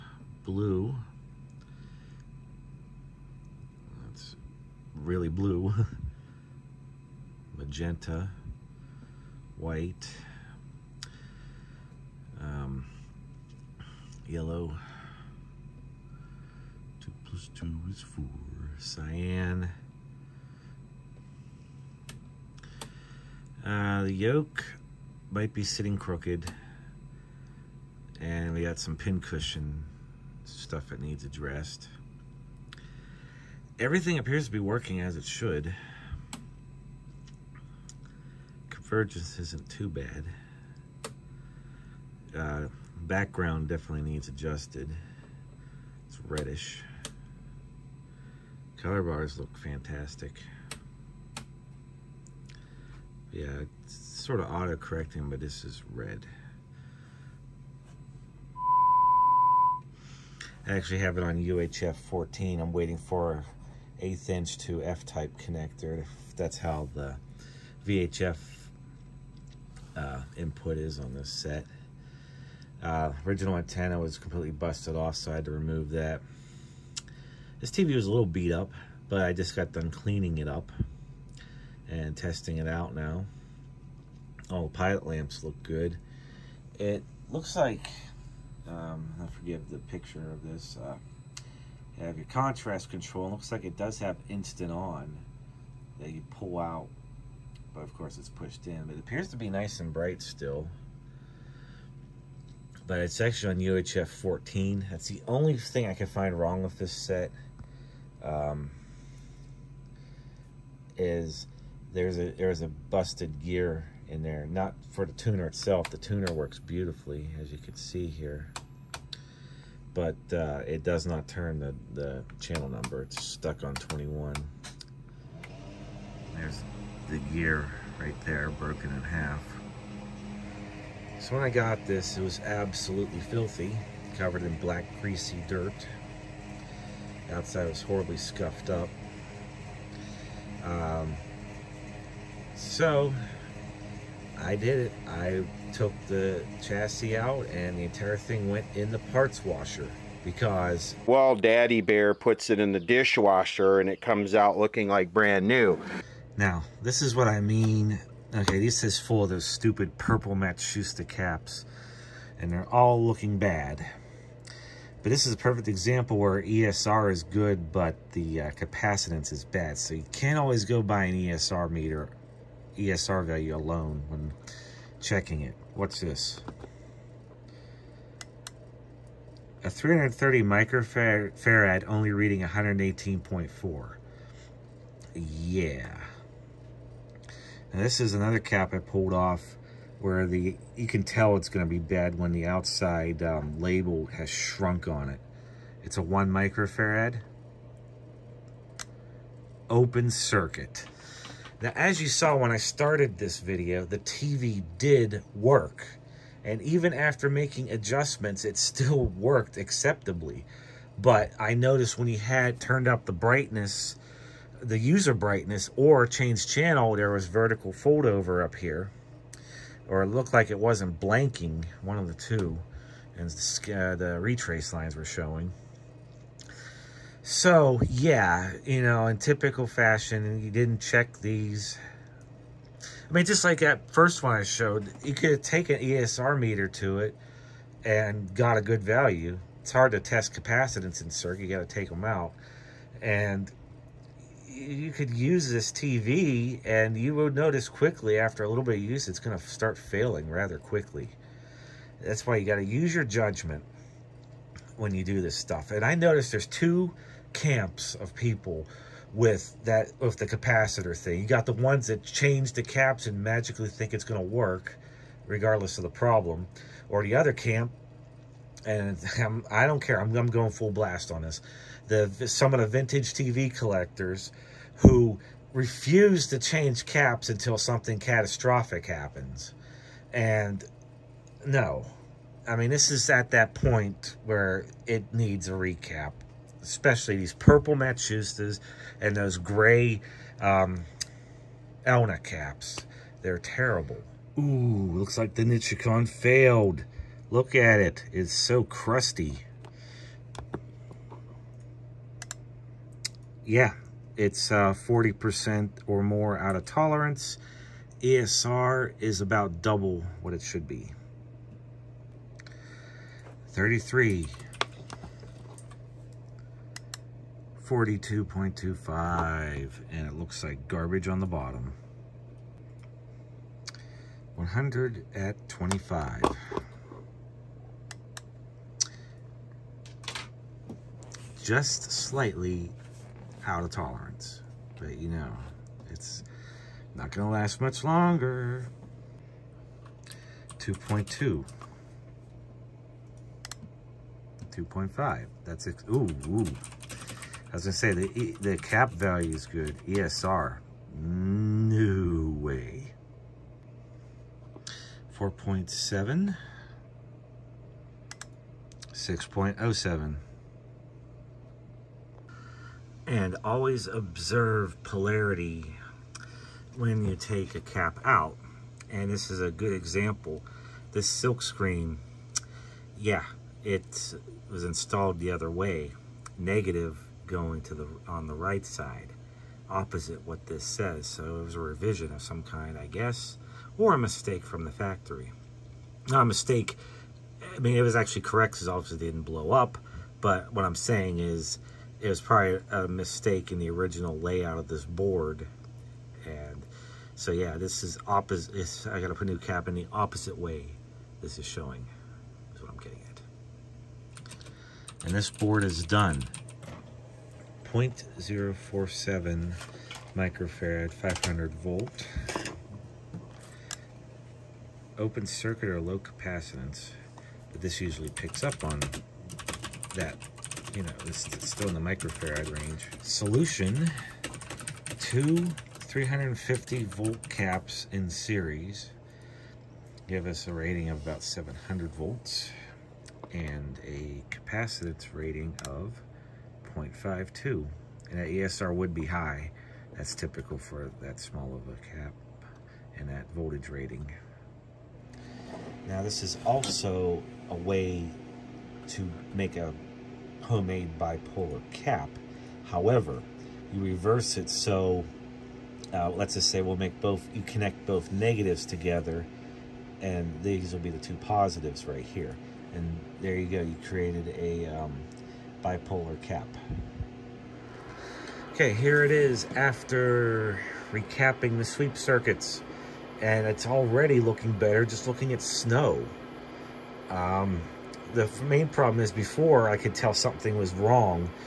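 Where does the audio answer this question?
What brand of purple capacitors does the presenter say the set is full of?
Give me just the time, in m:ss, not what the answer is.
2:40.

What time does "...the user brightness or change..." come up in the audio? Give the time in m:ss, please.
3:34.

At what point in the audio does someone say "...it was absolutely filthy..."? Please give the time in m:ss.
2:12.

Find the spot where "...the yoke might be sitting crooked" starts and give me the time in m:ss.
0:24.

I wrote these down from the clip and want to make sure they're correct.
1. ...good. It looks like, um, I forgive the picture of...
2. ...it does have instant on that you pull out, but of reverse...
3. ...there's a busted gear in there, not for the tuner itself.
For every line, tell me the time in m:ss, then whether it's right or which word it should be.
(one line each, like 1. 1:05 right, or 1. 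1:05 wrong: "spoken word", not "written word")
1. 1:25 right
2. 1:33 wrong: "course", not "reverse"
3. 1:52 right.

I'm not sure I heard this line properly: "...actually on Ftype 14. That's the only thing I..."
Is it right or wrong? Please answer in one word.
wrong.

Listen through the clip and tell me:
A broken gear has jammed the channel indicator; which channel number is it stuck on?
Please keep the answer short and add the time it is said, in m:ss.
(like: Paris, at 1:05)
21, at 2:03.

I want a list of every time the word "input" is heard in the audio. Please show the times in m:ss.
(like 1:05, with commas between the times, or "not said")
1:10.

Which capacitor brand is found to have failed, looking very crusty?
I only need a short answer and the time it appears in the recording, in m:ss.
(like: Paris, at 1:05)
Nichicon, at 4:55.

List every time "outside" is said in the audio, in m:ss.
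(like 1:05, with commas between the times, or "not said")
2:17, 3:12.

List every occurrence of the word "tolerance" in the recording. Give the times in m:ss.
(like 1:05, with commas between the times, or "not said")
5:06, 5:33.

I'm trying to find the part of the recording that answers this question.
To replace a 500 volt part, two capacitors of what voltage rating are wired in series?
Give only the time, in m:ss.
7:05.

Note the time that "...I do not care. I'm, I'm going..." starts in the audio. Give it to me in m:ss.
4:29.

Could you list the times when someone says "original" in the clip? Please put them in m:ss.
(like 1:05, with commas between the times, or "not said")
1:13, 6:33.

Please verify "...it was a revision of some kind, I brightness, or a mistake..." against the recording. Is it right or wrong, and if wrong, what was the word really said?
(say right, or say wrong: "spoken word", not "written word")
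wrong: "guess", not "brightness".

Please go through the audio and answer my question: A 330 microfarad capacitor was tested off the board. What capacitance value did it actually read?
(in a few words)
118.4.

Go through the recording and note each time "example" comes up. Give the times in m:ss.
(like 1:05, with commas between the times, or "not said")
2:45, 6:09.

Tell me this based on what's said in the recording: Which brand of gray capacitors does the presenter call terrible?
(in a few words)
Elna.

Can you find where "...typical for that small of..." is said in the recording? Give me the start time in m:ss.
7:20.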